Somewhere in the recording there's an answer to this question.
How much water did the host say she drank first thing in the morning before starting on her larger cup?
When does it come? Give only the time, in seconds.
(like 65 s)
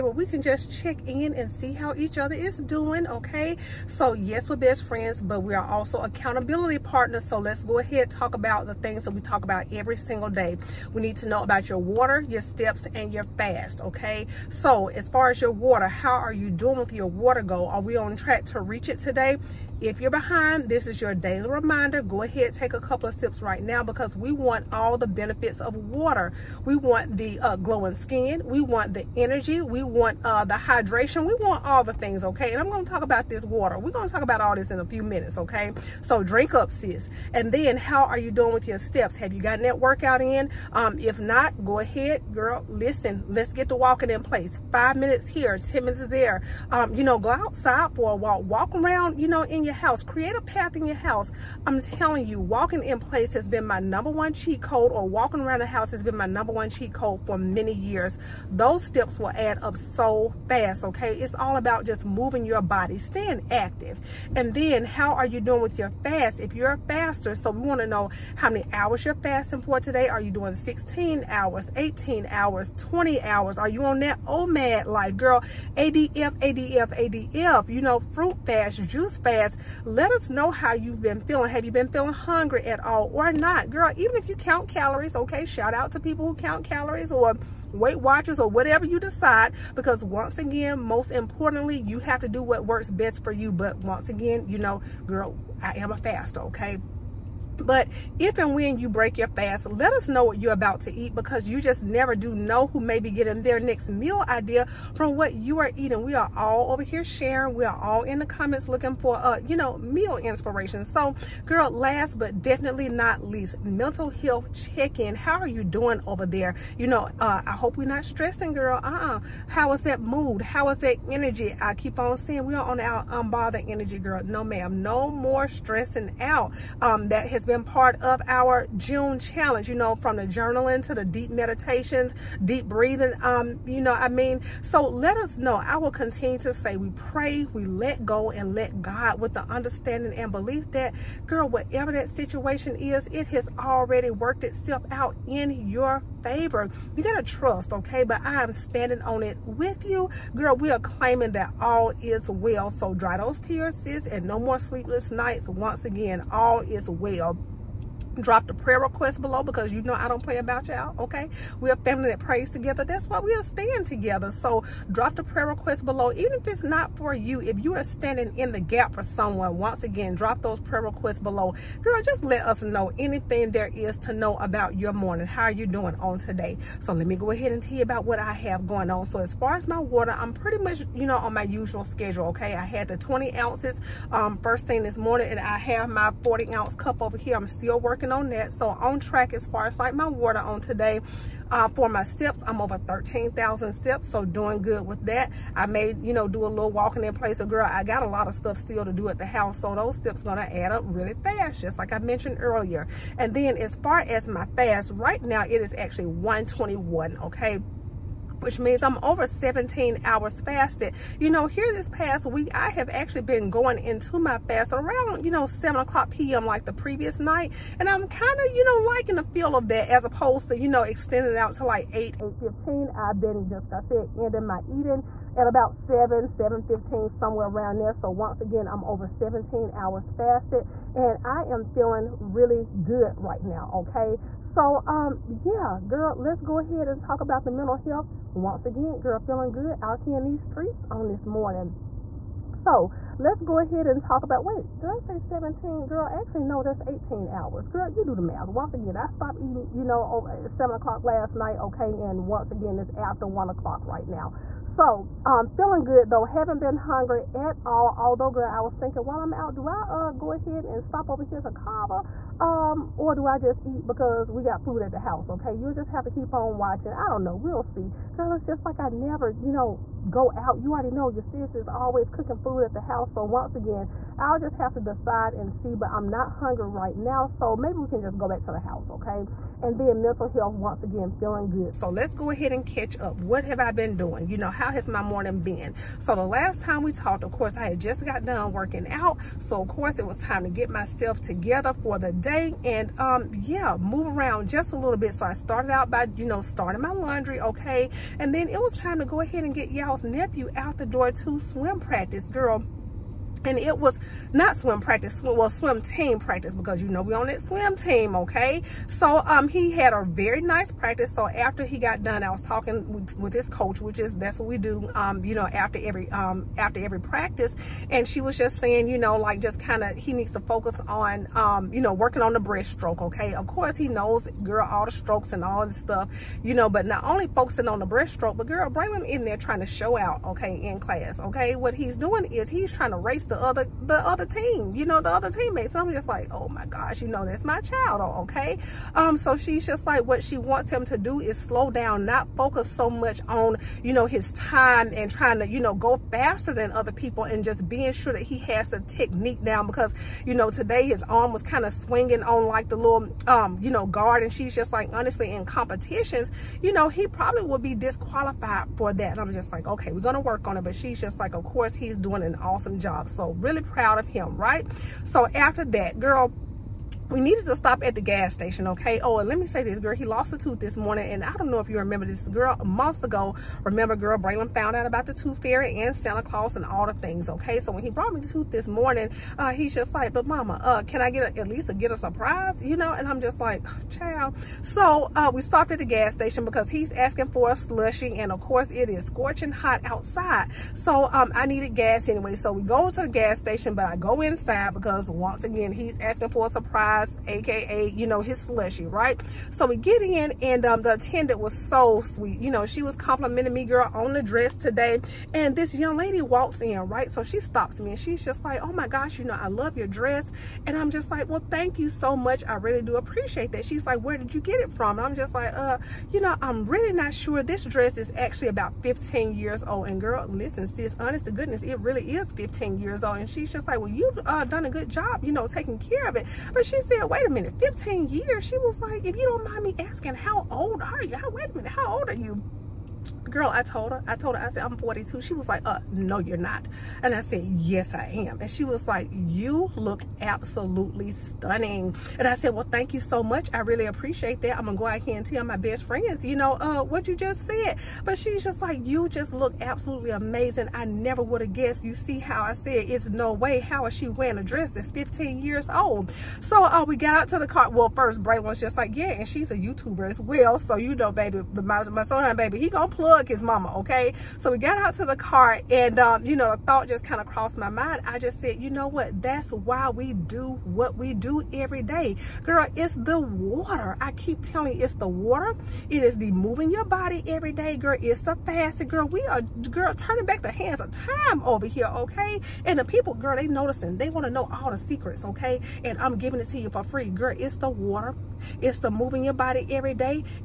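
182 s.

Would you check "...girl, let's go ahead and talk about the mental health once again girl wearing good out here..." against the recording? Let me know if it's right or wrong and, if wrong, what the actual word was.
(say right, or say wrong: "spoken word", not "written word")
wrong: "feeling", not "wearing".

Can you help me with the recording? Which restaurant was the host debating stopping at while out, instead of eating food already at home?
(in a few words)
Cava.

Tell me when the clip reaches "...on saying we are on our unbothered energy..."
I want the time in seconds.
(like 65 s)
121 s.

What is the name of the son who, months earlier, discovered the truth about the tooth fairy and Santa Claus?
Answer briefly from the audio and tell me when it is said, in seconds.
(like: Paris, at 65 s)
Braylon, at 374 s.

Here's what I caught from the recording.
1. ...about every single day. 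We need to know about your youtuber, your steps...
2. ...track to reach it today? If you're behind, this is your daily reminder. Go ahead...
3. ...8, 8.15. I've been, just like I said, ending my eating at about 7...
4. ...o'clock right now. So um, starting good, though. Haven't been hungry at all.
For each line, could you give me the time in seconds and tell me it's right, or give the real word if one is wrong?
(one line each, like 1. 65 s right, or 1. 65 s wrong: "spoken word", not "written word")
1. 9 s wrong: "water", not "youtuber"
2. 18 s right
3. 221 s right
4. 253 s wrong: "feeling", not "starting".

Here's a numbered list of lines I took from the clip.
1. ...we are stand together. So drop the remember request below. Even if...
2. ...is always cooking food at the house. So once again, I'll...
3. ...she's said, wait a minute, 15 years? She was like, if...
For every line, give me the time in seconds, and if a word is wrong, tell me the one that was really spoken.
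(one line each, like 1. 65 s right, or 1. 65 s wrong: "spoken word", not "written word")
1. 163 s wrong: "prayer", not "remember"
2. 271 s right
3. 426 s right.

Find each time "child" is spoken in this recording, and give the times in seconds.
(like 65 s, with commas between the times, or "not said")
337 s, 383 s.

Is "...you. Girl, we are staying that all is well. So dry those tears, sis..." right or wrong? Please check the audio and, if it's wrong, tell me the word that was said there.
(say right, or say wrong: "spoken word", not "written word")
wrong: "claiming", not "staying".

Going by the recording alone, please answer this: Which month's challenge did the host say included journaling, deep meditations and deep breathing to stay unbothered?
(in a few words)
June.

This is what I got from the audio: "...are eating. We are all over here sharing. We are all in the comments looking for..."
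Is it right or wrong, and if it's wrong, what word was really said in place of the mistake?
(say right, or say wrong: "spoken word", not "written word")
right.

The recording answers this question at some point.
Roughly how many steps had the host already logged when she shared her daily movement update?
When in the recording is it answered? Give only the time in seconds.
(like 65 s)
192 s.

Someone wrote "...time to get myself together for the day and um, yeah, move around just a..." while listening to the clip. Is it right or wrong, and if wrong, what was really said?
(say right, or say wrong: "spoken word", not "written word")
right.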